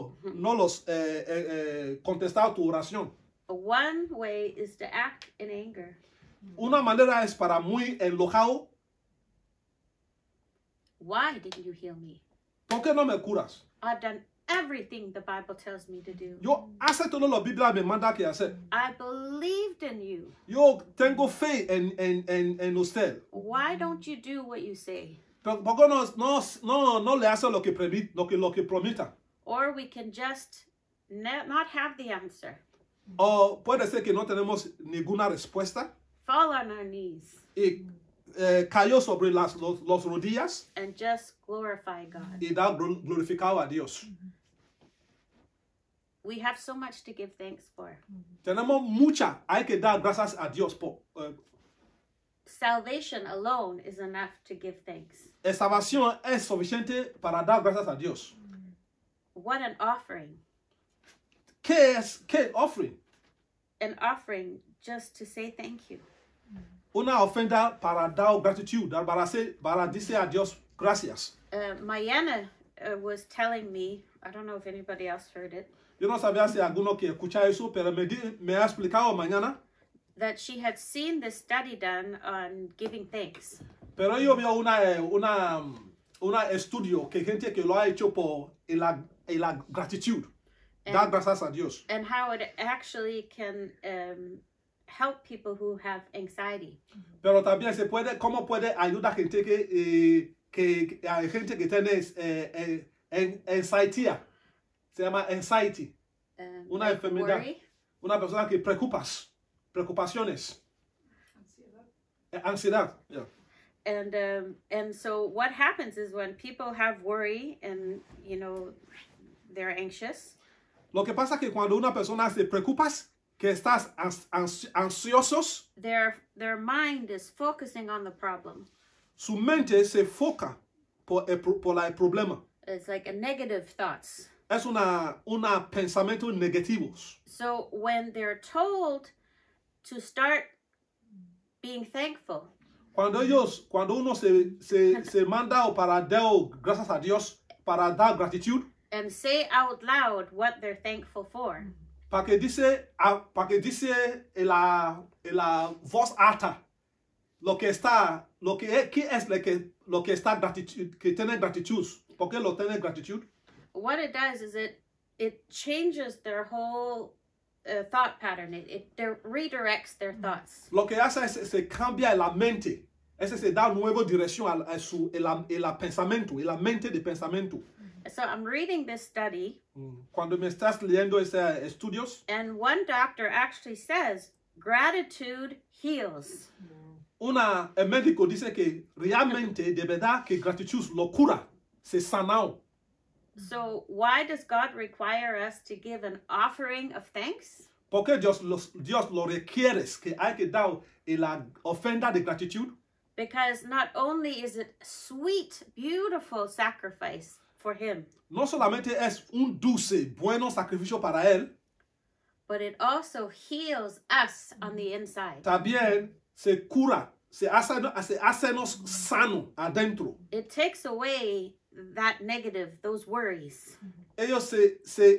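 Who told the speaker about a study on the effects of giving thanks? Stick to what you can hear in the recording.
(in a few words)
Mayana.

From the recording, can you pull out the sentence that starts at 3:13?
So why does God require us to give an offering of thanks?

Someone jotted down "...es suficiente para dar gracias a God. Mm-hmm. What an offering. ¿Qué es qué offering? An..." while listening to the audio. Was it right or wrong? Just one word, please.
wrong.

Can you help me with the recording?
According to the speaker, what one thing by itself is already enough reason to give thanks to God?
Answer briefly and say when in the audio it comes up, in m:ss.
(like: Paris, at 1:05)
Salvation, at 0:52.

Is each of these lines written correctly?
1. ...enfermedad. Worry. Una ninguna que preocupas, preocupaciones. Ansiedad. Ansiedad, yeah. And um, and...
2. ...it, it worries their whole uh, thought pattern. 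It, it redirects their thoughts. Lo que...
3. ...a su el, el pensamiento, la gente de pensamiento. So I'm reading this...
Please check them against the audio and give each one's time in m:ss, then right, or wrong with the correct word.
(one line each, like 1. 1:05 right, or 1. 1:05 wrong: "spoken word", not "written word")
1. 1:46 wrong: "persona", not "ninguna"
2. 2:44 wrong: "changes", not "worries"
3. 2:54 wrong: "mente", not "gente".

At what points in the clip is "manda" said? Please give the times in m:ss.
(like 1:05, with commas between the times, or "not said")
0:17, 2:25.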